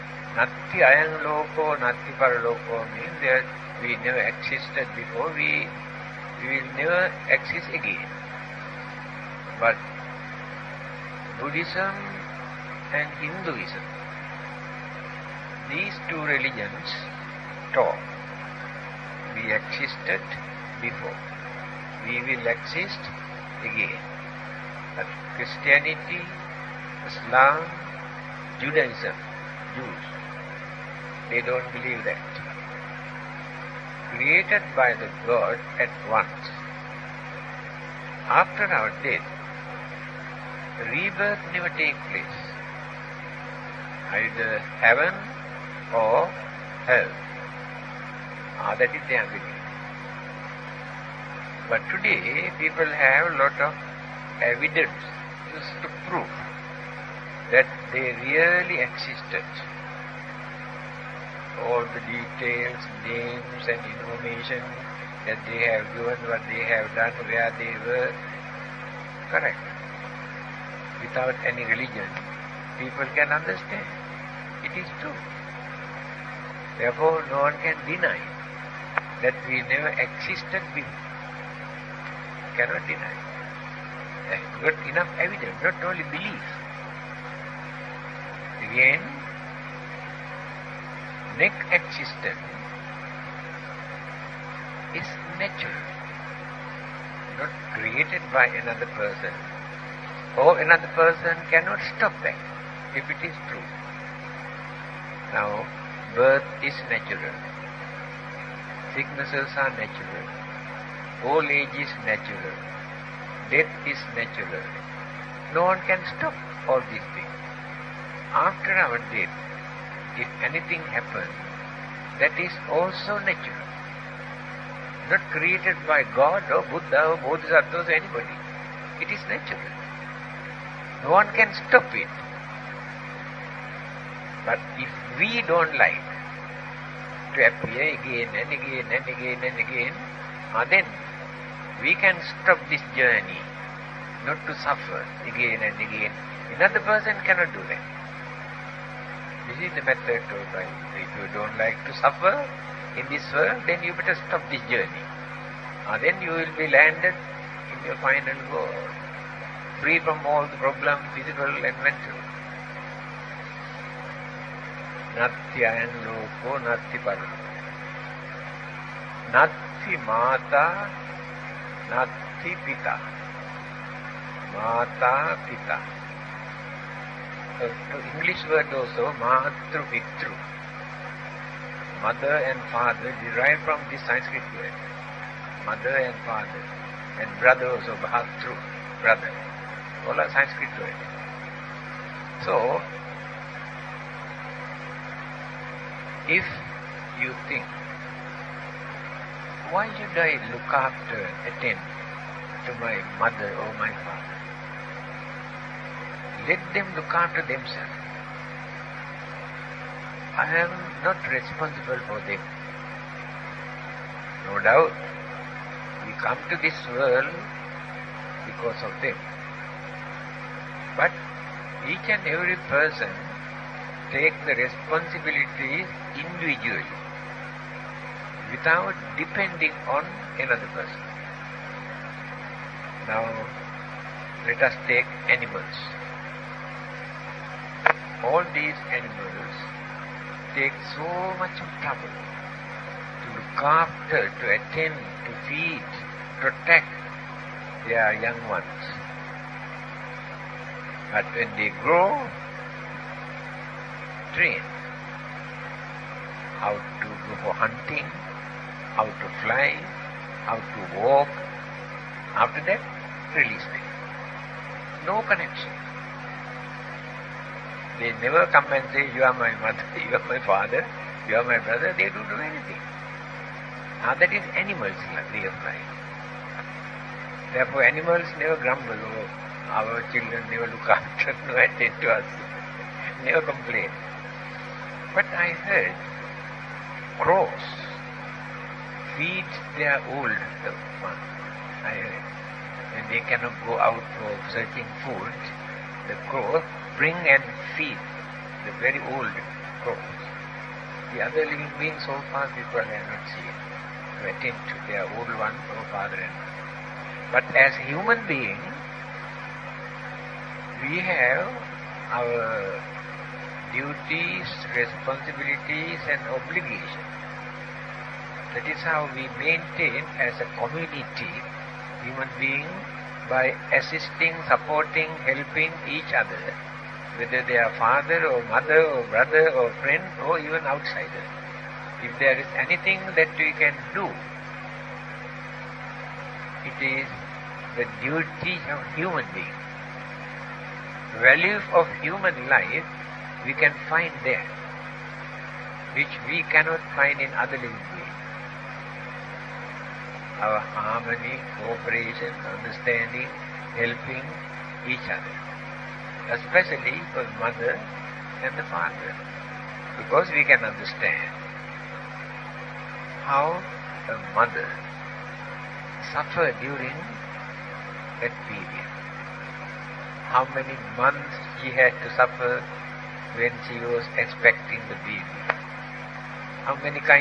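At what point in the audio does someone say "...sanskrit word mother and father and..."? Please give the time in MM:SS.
03:04.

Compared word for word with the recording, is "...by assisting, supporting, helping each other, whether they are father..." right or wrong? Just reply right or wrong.
right.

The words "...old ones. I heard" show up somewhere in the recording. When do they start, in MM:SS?
04:50.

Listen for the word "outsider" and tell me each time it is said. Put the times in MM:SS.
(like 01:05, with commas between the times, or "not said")
05:30.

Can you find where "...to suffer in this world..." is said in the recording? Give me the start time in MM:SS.
02:31.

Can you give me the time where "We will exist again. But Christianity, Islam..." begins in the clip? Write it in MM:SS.
00:22.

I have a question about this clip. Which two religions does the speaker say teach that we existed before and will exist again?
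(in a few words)
Buddhism and Hinduism.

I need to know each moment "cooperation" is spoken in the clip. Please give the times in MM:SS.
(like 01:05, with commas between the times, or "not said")
05:51.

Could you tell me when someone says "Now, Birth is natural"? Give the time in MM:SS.
01:45.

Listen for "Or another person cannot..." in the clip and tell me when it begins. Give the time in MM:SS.
01:40.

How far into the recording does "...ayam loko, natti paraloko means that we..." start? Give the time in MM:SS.
00:00.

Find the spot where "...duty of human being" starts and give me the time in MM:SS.
05:37.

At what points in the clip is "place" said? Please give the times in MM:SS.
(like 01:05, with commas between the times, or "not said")
00:42.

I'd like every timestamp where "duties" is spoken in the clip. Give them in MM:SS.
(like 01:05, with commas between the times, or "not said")
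05:13.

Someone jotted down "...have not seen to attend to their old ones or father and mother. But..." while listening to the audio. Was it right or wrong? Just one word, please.
right.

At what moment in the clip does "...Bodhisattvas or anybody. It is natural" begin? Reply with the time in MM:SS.
02:07.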